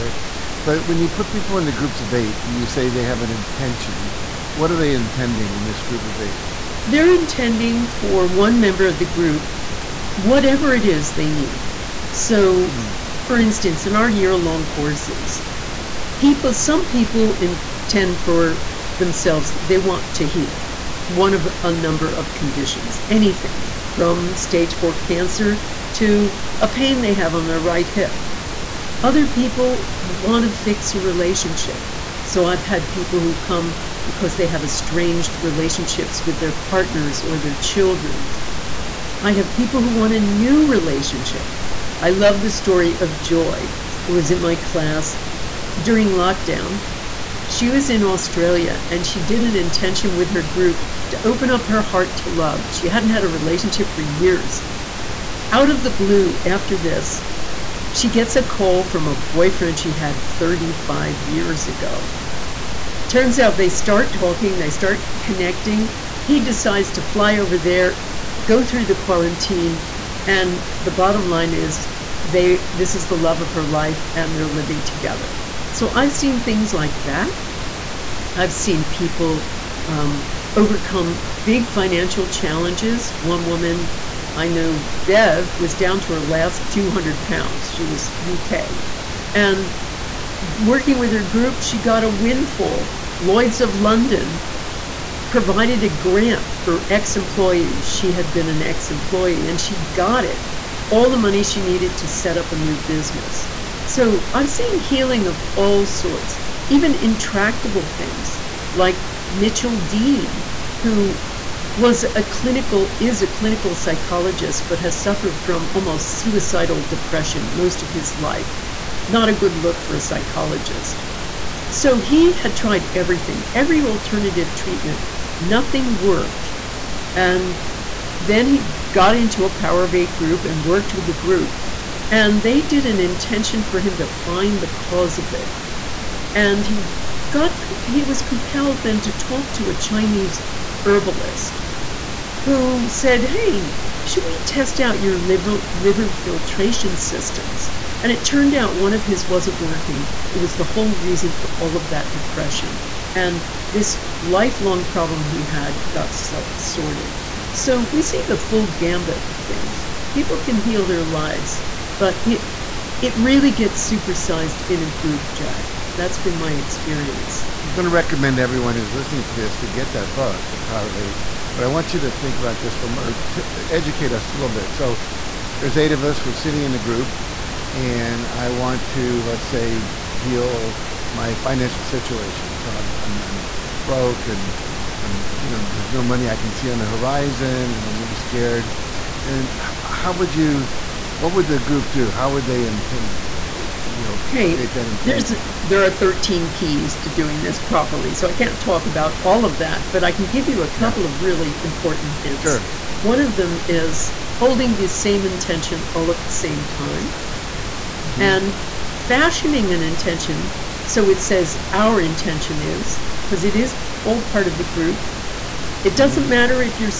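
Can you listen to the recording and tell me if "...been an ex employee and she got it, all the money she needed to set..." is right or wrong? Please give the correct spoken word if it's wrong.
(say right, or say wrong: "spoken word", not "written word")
right.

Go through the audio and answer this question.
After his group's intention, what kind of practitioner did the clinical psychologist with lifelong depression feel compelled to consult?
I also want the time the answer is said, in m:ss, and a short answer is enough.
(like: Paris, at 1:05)
Chinese herbalist, at 2:19.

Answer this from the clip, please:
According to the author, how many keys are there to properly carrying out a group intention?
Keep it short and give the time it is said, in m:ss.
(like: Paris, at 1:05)
13, at 3:15.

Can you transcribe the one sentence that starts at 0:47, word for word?
She was in Australia and she did an intention with her group to open up her heart to love.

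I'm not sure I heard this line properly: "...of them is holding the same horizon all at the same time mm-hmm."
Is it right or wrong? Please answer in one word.
wrong.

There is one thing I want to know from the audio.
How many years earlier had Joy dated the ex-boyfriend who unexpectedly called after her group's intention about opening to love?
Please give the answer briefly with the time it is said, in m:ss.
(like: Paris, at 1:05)
35, at 1:00.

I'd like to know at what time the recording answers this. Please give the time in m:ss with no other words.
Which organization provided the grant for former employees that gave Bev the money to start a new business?
1:33.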